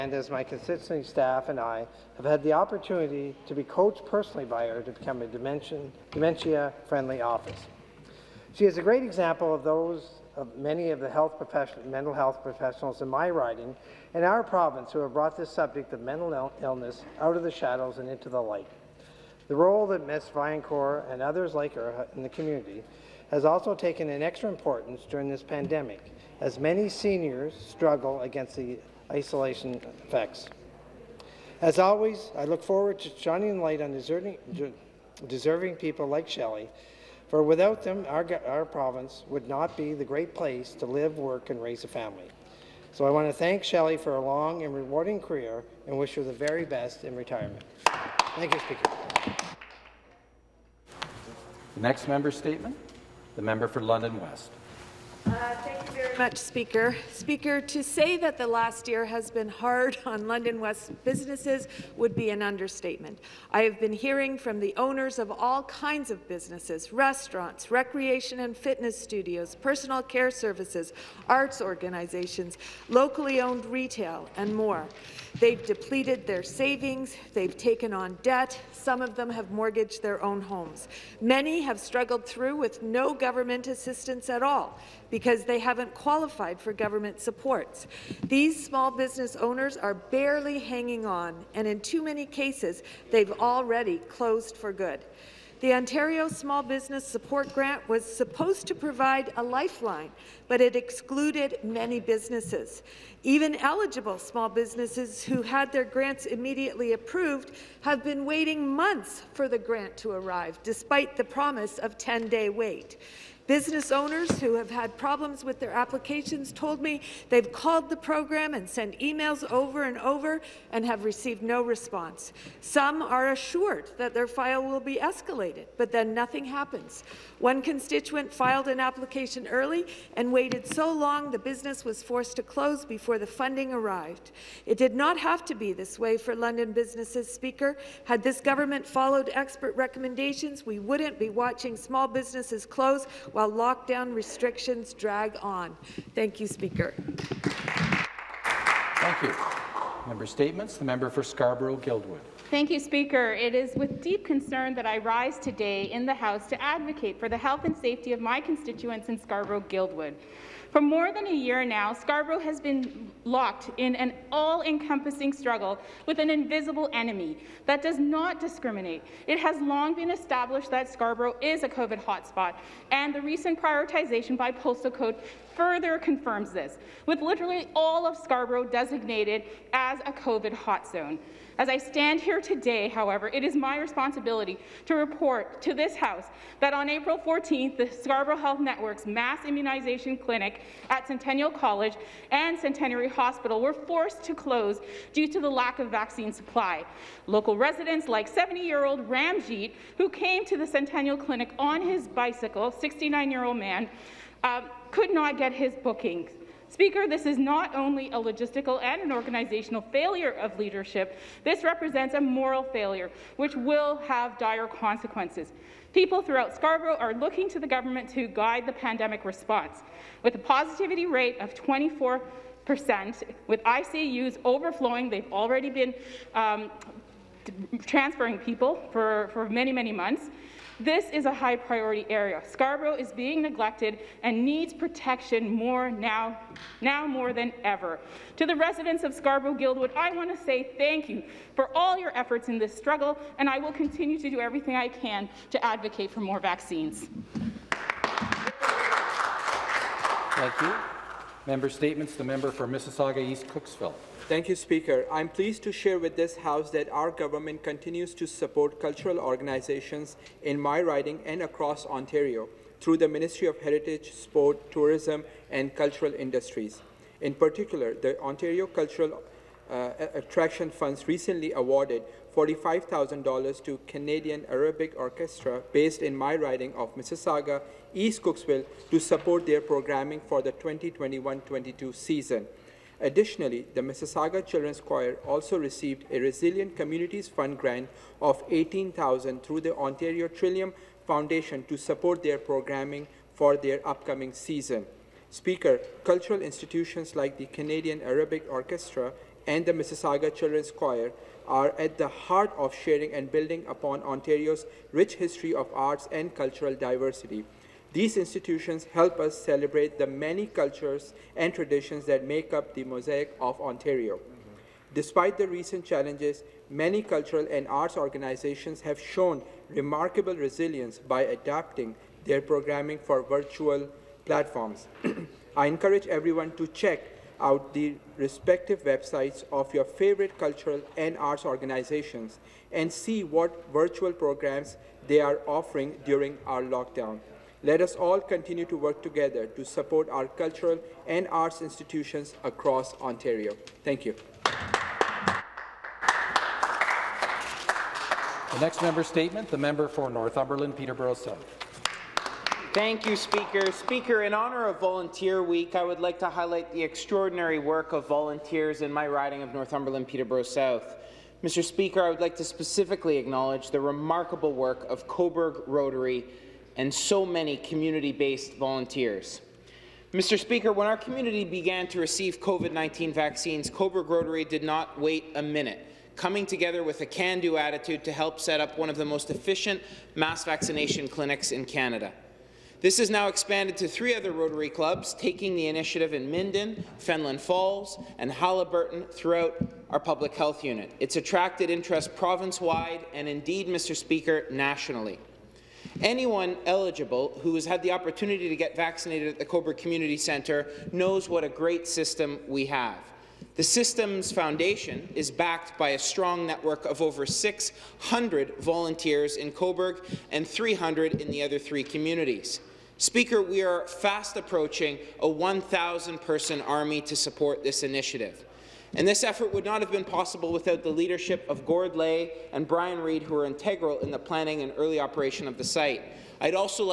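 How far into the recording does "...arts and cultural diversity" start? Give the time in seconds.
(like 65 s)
305 s.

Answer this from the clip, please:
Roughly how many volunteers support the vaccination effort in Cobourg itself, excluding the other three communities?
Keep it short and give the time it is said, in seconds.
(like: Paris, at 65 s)
600, at 407 s.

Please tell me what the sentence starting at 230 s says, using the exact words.
This is a high priority area.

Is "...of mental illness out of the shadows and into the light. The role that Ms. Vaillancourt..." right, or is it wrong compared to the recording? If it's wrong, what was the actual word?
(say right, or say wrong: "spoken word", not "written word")
right.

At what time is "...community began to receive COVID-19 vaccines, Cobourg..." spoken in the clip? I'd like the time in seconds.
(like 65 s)
370 s.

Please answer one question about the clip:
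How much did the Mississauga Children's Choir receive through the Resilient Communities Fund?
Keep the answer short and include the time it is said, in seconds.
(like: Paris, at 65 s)
$18,000, at 288 s.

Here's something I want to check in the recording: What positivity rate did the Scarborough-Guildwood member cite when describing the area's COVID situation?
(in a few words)
24 percent.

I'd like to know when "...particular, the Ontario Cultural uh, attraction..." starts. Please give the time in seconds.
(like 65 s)
267 s.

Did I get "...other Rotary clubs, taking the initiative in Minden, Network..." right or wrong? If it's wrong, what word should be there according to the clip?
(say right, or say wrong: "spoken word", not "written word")
wrong: "Fenelon", not "Network".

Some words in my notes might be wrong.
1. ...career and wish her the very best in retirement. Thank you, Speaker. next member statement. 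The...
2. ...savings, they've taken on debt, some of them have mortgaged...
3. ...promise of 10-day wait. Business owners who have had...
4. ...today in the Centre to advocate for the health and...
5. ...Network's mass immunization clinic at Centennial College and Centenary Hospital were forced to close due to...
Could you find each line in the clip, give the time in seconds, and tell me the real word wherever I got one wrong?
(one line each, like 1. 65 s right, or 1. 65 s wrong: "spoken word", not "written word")
1. 45 s right
2. 76 s right
3. 111 s right
4. 155 s wrong: "House", not "Centre"
5. 188 s right.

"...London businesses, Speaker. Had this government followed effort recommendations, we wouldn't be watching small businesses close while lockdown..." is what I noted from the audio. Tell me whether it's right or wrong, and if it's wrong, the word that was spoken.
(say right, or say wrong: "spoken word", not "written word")
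wrong: "expert", not "effort".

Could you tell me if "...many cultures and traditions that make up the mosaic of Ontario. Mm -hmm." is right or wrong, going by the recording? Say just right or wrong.
right.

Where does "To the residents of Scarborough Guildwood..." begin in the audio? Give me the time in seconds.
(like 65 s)
238 s.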